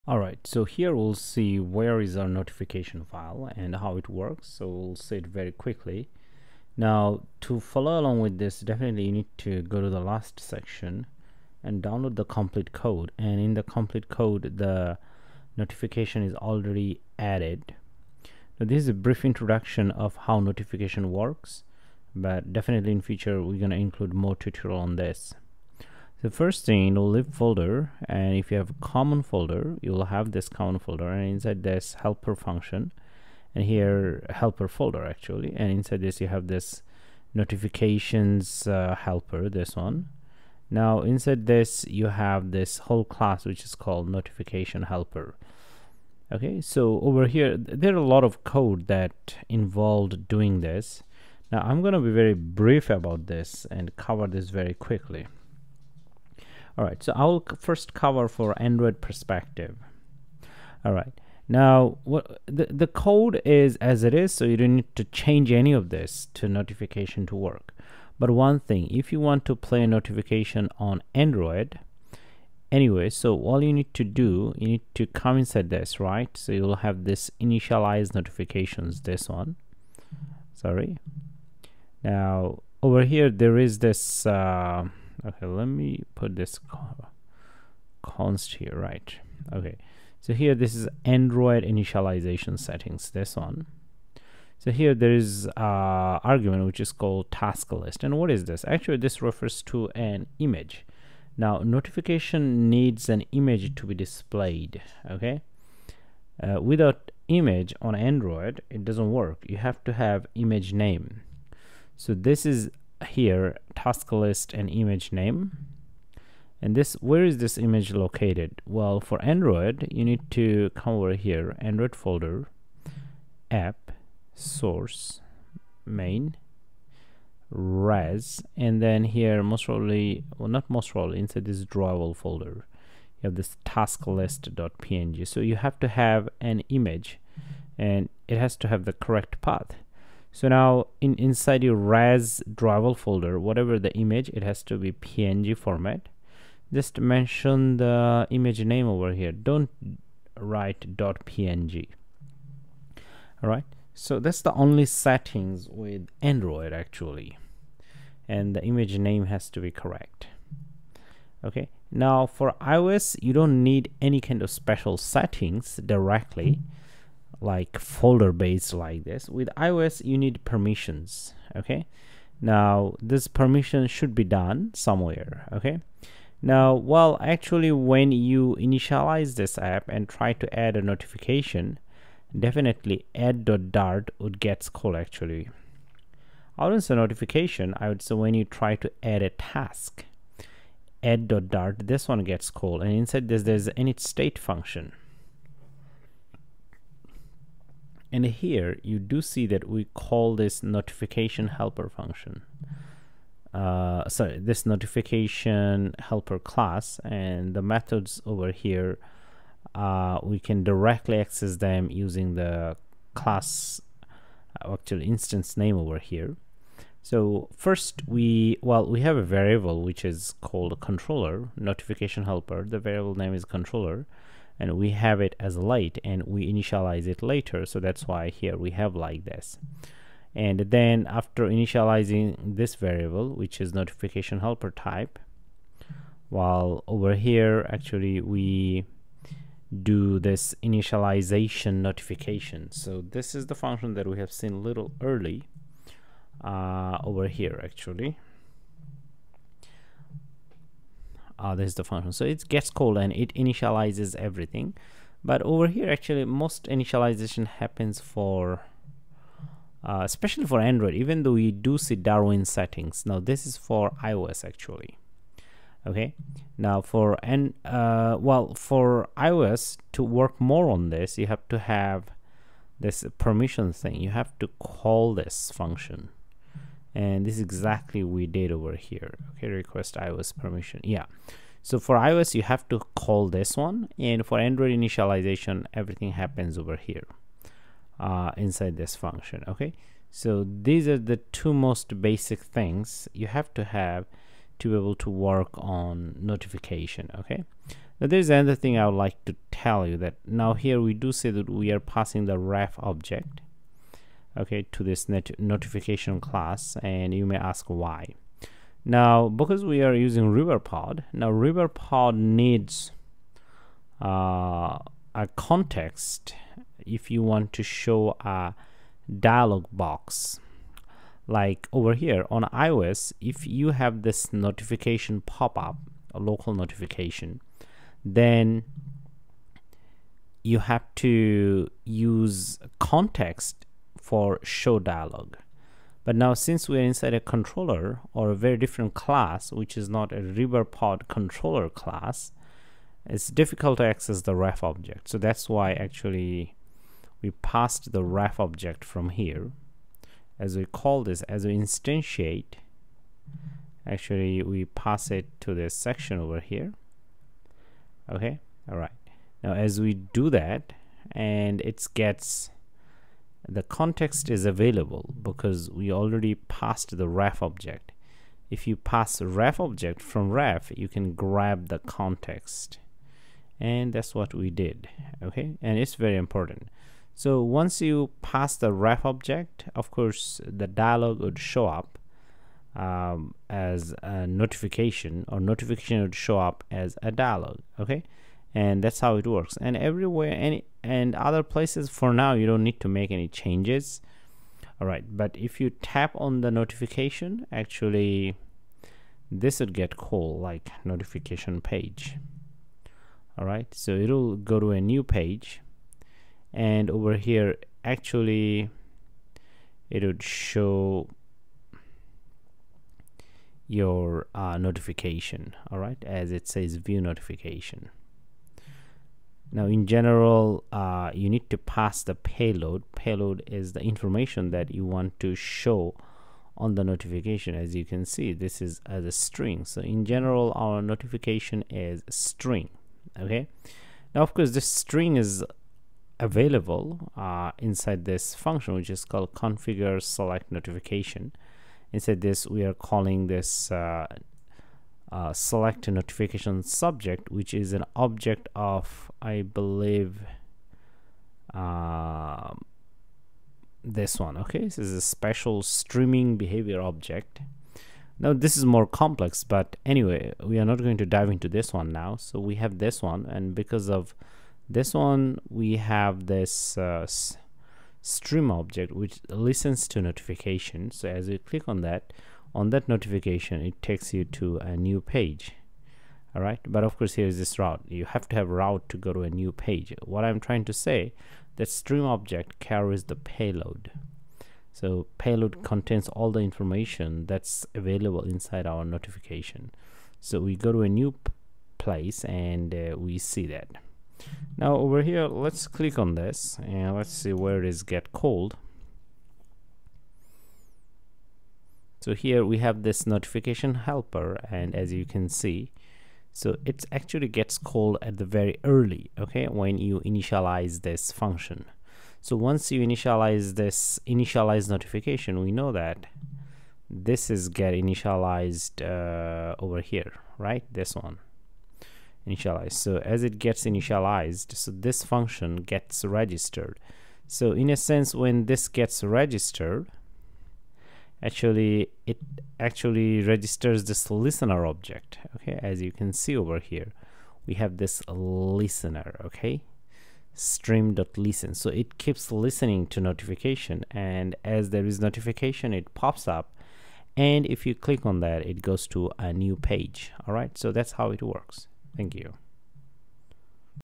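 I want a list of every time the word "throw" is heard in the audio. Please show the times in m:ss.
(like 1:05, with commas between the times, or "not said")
not said.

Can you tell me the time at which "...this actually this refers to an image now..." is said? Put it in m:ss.
1:38.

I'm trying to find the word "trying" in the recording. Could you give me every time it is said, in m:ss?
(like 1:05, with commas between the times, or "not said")
8:00.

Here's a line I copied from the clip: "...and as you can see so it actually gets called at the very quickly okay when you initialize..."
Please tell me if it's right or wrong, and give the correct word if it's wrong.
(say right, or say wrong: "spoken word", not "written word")
wrong: "early", not "quickly".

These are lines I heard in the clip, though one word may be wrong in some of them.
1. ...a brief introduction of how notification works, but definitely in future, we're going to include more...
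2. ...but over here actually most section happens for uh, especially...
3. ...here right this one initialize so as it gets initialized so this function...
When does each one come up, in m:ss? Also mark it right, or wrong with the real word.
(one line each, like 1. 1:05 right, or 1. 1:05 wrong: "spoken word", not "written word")
1. 0:18 right
2. 4:15 wrong: "initialization", not "section"
3. 8:39 right.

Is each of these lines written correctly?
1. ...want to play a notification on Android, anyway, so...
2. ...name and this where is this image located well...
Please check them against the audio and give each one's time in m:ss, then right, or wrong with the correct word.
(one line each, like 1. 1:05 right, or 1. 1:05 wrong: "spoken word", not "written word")
1. 1:09 right
2. 1:55 right.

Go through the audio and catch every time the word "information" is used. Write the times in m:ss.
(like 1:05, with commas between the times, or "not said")
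7:03, 8:06.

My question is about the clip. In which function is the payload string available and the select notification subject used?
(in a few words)
configure select notification.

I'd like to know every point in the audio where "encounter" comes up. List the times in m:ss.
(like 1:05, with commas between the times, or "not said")
not said.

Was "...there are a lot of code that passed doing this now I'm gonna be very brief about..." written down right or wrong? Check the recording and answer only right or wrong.
wrong.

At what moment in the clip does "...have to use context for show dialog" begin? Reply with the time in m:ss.
5:30.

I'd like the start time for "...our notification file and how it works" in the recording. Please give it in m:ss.
0:02.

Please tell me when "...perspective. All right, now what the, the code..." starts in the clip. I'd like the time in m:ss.
0:59.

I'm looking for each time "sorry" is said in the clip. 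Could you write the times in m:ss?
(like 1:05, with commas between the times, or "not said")
1:20, 3:24.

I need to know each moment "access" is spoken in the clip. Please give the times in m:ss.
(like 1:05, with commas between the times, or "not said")
3:31, 5:43.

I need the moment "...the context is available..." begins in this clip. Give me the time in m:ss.
6:03.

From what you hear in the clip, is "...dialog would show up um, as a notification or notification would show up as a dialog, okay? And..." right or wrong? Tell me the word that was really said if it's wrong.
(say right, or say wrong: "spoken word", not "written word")
right.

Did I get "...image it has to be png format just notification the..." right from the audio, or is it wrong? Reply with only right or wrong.
wrong.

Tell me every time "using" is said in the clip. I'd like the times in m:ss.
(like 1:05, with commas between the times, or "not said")
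3:31, 5:09.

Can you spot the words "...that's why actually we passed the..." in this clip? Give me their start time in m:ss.
5:45.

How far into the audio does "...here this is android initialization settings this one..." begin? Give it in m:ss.
1:30.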